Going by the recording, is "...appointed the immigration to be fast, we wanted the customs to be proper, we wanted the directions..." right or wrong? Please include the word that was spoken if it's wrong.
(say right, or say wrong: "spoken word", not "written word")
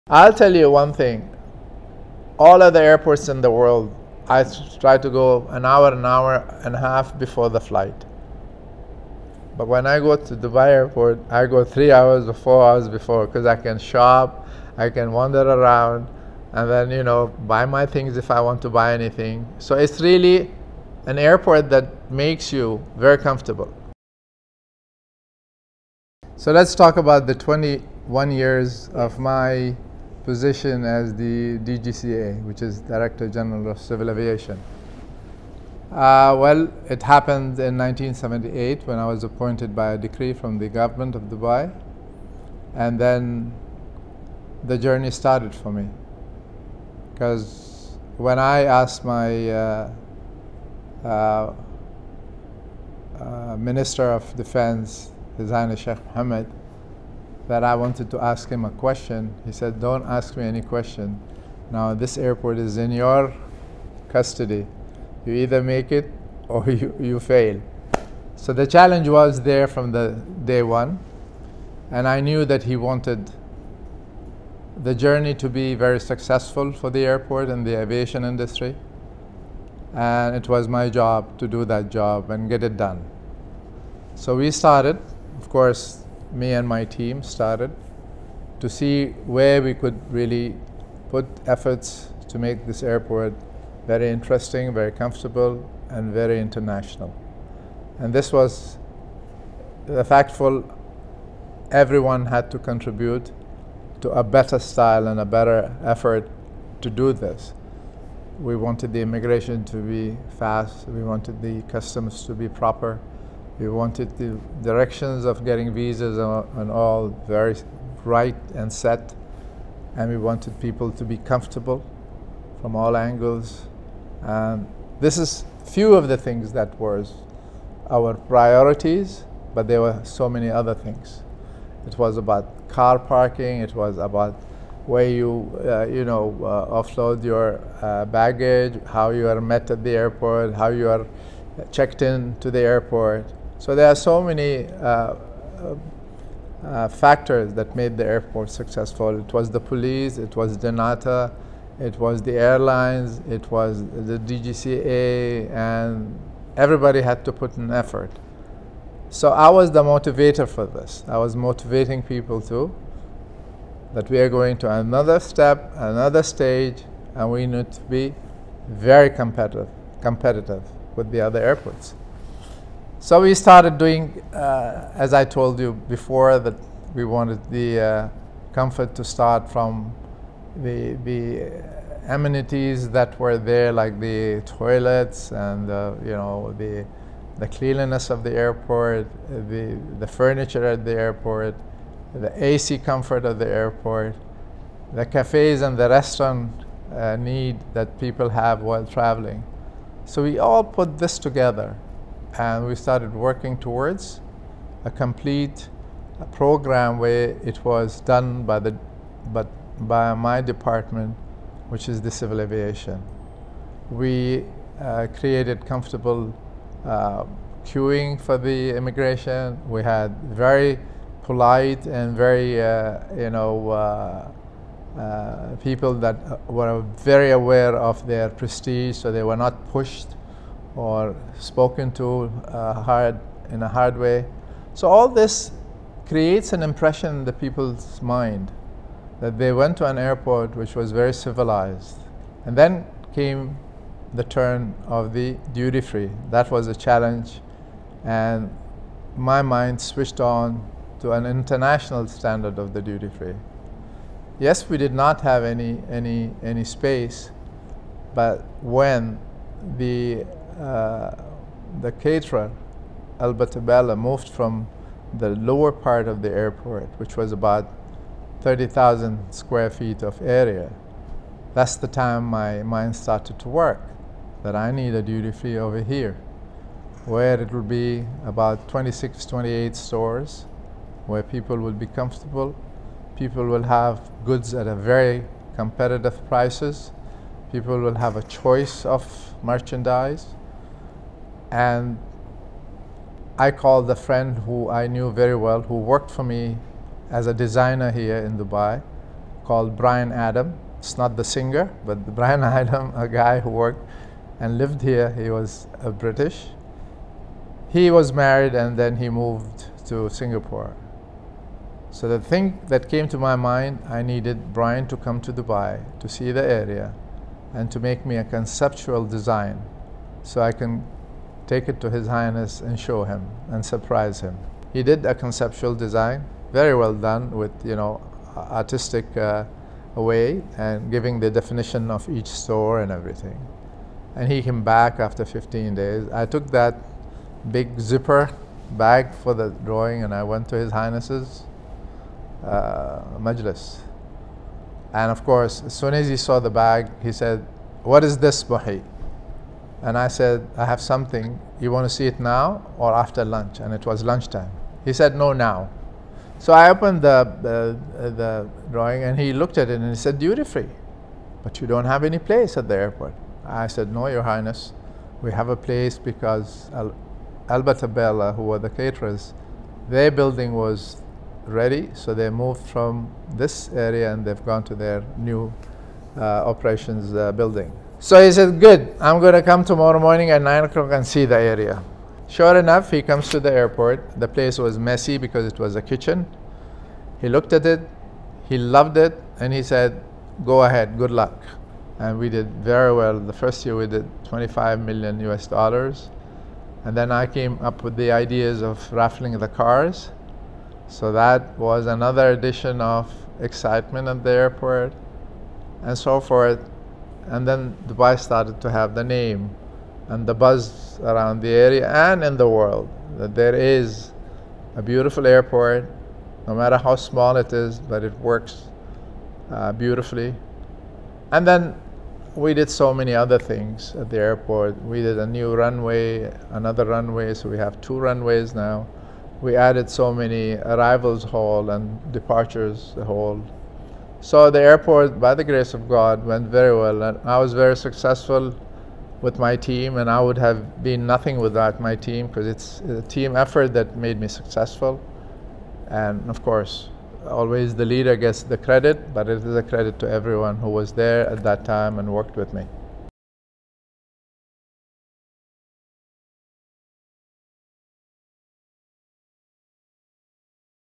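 wrong: "wanted", not "appointed".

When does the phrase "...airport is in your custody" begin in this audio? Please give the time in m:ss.
1:02.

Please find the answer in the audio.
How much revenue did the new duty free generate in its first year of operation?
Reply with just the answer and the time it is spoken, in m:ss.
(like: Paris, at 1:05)
25 million US dollars, at 6:34.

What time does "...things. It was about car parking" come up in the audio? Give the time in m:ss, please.
2:10.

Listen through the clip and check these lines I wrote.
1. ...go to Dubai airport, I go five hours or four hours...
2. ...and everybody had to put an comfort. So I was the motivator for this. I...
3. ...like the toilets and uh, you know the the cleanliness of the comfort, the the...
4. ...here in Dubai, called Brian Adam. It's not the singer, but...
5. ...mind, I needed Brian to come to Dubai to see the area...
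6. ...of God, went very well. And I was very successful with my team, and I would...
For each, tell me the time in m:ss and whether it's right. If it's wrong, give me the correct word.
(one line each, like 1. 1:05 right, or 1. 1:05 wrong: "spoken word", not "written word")
1. 0:09 wrong: "three", not "five"
2. 2:35 wrong: "effort", not "comfort"
3. 3:03 wrong: "airport", not "comfort"
4. 4:57 right
5. 5:13 right
6. 7:15 right.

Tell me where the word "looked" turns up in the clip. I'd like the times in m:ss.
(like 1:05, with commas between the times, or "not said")
5:59, 6:27.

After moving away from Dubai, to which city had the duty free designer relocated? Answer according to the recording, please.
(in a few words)
Singapore.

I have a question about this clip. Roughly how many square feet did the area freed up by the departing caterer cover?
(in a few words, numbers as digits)
30,000.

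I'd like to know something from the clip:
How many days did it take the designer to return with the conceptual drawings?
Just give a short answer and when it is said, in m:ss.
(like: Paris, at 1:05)
15, at 5:35.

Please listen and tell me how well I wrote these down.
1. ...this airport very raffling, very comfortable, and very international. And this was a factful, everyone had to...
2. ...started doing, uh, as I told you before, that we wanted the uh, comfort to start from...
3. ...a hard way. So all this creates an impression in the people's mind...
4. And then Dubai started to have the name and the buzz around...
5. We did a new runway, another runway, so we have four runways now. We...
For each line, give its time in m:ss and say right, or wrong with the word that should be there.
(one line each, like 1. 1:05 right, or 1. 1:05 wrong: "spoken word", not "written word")
1. 1:32 wrong: "interesting", not "raffling"
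2. 2:53 right
3. 3:53 right
4. 6:47 right
5. 7:04 wrong: "two", not "four".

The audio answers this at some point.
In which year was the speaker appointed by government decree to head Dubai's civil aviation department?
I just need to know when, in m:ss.
0:37.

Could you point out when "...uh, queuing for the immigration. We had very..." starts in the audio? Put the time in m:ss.
3:36.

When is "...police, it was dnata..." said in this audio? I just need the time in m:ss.
2:29.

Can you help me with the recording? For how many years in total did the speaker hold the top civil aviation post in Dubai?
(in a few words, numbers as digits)
21.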